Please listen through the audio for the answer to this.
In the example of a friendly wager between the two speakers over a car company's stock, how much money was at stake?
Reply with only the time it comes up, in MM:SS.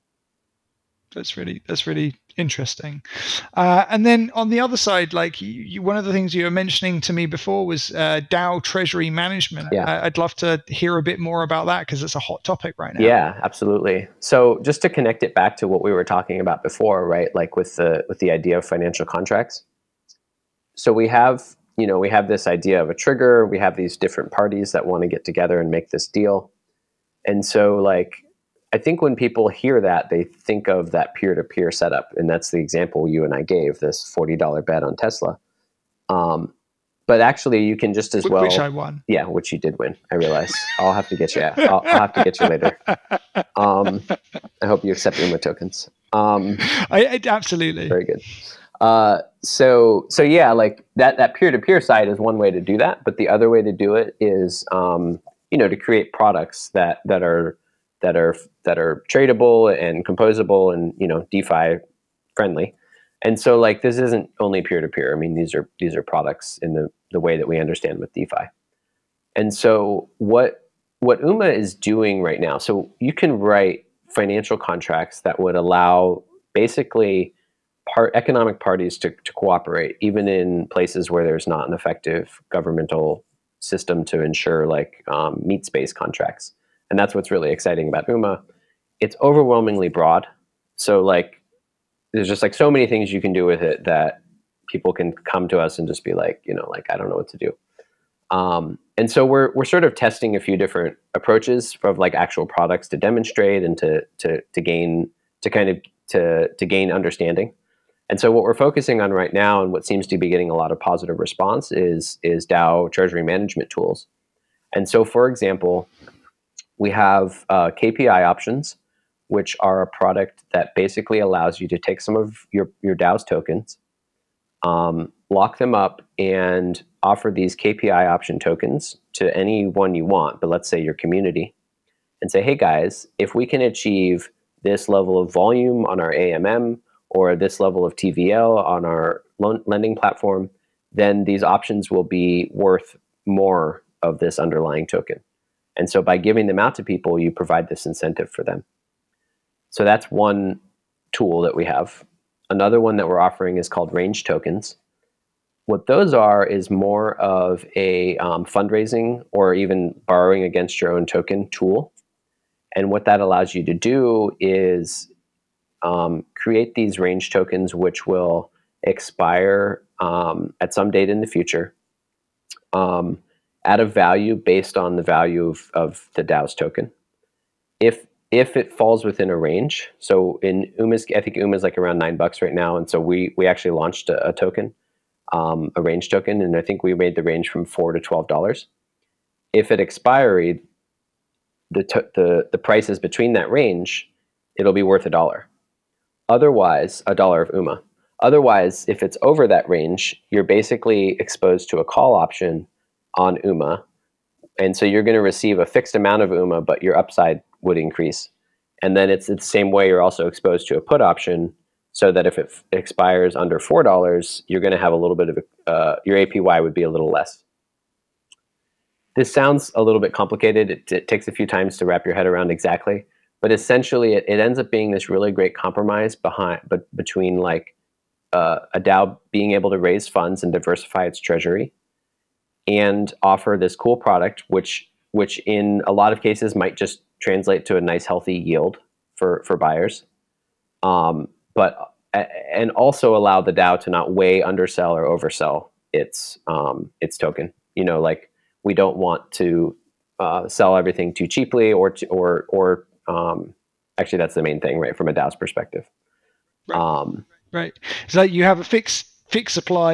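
00:34.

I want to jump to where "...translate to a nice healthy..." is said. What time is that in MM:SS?
03:57.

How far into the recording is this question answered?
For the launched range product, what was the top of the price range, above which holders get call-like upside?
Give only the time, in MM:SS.
03:07.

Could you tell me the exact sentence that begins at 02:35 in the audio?
What those are is more of a um, fundraising or even borrowing against your own token tool.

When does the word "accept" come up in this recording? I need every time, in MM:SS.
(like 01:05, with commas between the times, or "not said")
00:44.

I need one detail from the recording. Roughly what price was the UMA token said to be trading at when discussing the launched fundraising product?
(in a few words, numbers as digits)
$9.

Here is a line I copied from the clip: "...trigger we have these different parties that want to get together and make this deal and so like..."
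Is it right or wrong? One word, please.
right.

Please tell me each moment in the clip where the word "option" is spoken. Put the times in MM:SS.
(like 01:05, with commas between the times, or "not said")
01:58, 02:08, 02:21, 03:22, 03:31.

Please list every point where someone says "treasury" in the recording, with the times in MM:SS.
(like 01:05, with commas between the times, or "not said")
00:08, 01:52, 03:51.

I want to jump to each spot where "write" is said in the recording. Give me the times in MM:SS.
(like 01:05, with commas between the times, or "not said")
01:13.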